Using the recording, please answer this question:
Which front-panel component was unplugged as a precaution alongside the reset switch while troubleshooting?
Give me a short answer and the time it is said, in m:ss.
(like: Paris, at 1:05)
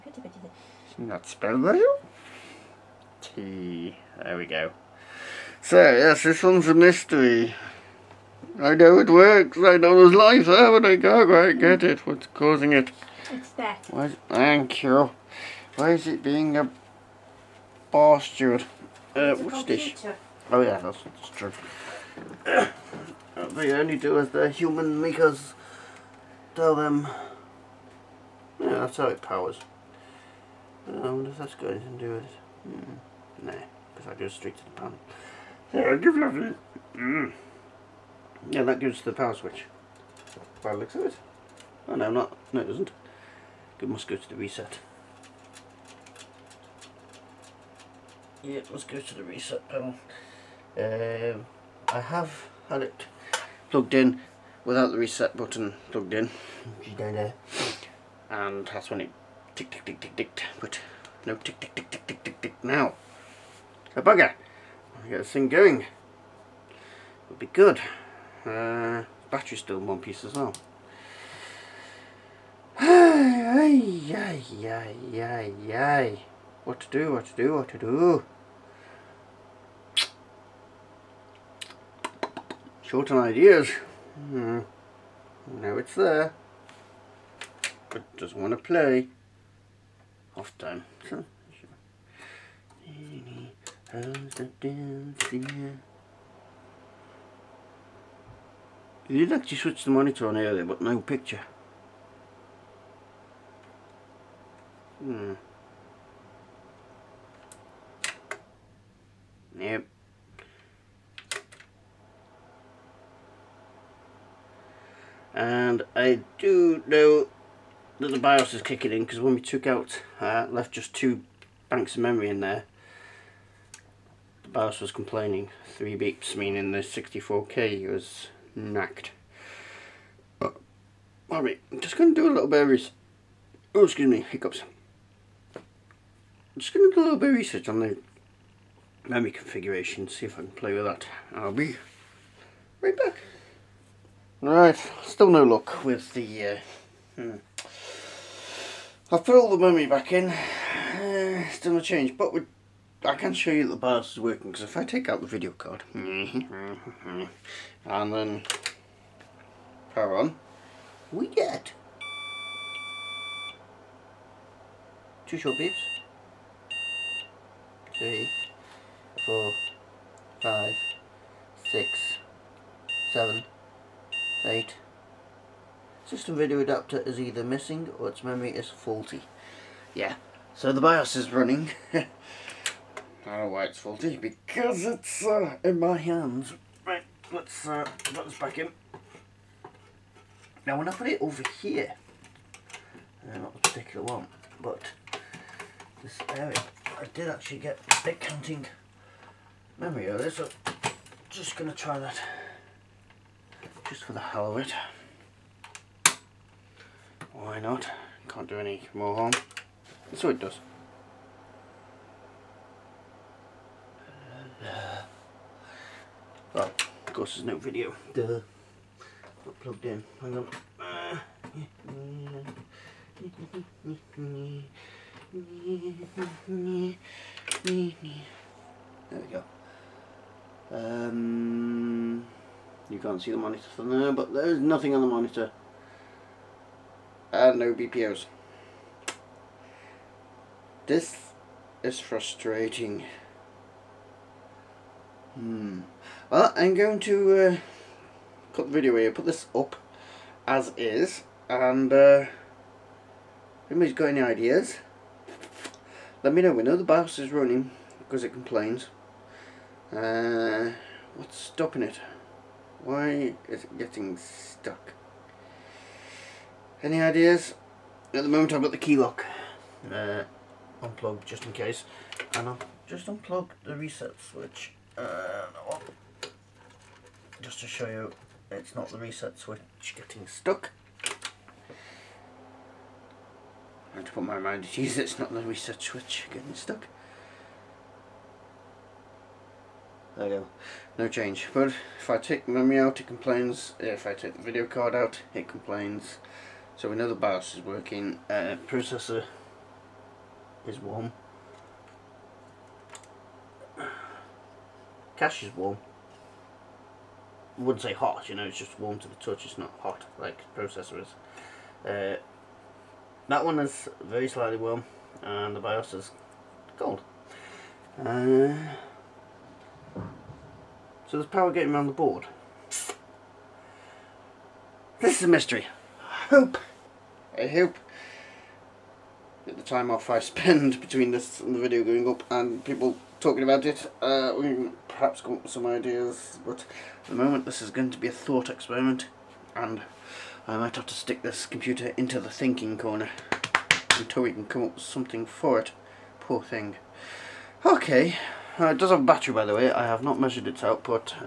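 key lock, at 4:28.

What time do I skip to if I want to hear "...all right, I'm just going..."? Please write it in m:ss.
2:11.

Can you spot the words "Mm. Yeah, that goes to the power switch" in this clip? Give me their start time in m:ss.
0:36.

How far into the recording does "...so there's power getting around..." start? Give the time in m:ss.
5:21.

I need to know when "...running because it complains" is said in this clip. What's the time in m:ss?
4:17.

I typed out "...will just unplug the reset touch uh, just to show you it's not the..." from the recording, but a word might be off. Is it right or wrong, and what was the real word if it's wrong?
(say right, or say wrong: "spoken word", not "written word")
wrong: "switch", not "touch".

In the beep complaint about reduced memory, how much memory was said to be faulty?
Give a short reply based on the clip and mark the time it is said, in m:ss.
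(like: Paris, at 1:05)
64K, at 2:06.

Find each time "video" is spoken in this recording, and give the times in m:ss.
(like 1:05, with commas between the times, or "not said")
2:35, 2:56, 3:37, 4:08, 4:54, 5:31.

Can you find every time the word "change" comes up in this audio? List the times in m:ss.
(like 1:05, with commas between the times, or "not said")
2:31, 4:51.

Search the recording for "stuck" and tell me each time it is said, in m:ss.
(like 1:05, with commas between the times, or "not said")
4:24, 4:40, 4:46.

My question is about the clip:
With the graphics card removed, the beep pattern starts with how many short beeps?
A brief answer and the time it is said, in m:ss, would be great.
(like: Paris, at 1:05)
2, at 2:45.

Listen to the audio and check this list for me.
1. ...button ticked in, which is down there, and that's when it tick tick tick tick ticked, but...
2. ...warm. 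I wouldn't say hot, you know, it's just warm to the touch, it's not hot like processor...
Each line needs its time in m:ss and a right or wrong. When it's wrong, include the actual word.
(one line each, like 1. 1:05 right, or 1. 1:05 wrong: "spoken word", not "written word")
1. 0:55 wrong: "plugged", not "ticked"
2. 5:05 right.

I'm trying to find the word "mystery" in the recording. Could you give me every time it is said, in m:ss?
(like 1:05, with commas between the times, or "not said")
0:06, 5:25.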